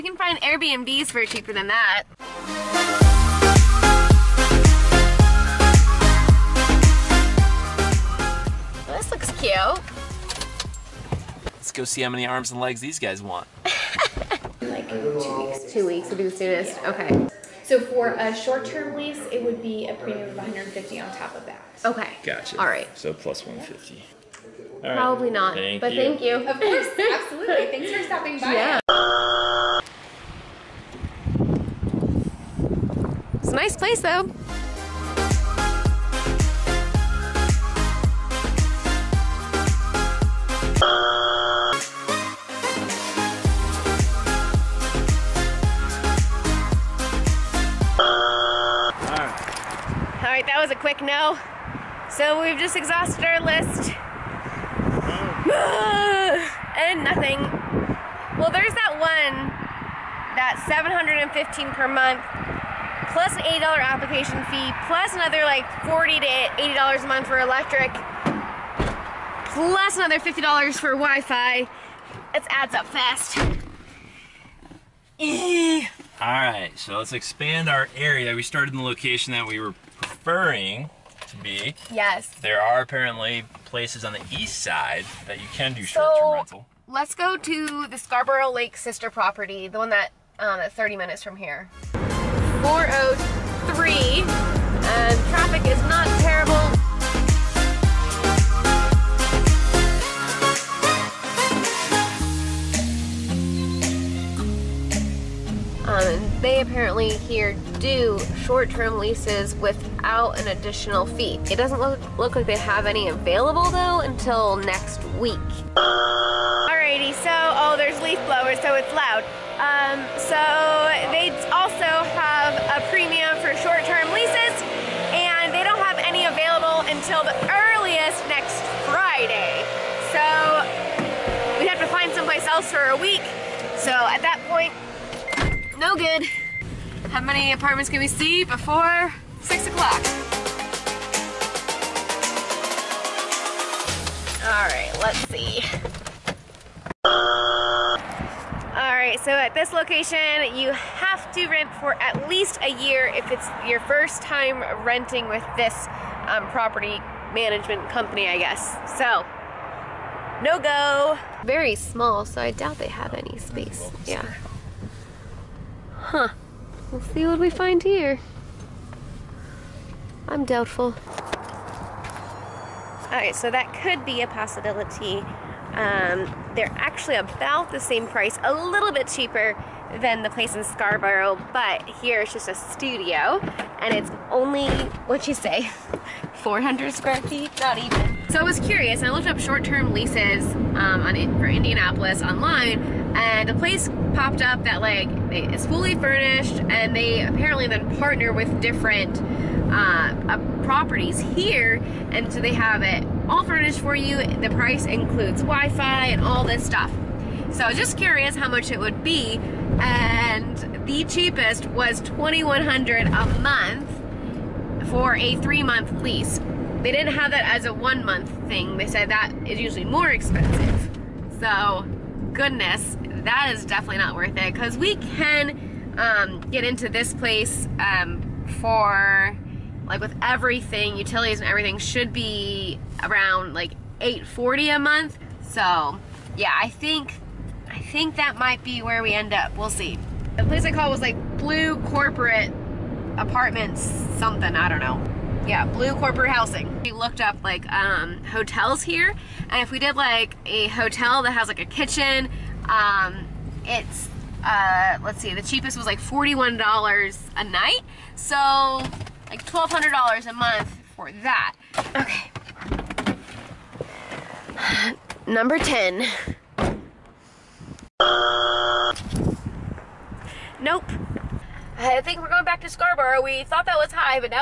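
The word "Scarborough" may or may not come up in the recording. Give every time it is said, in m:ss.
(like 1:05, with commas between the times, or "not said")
1:27, 3:00, 4:32.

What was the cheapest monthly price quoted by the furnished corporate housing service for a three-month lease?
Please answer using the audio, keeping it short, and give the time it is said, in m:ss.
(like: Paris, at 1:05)
$2,100, at 3:32.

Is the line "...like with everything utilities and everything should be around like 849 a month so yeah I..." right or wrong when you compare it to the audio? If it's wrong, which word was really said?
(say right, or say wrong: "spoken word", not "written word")
wrong: "840", not "849".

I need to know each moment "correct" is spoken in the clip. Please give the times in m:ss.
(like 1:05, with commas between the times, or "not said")
not said.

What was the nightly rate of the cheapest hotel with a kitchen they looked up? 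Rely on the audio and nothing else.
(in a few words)
$41.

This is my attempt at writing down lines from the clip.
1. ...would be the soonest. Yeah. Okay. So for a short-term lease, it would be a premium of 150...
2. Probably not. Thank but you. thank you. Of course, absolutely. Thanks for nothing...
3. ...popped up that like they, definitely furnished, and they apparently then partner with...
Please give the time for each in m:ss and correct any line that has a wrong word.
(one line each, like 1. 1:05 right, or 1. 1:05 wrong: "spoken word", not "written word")
1. 0:16 right
2. 0:24 wrong: "stopping", not "nothing"
3. 3:14 wrong: "fully", not "definitely".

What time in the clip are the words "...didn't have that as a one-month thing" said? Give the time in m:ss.
3:36.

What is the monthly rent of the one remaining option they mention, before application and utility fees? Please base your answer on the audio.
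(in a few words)
$715.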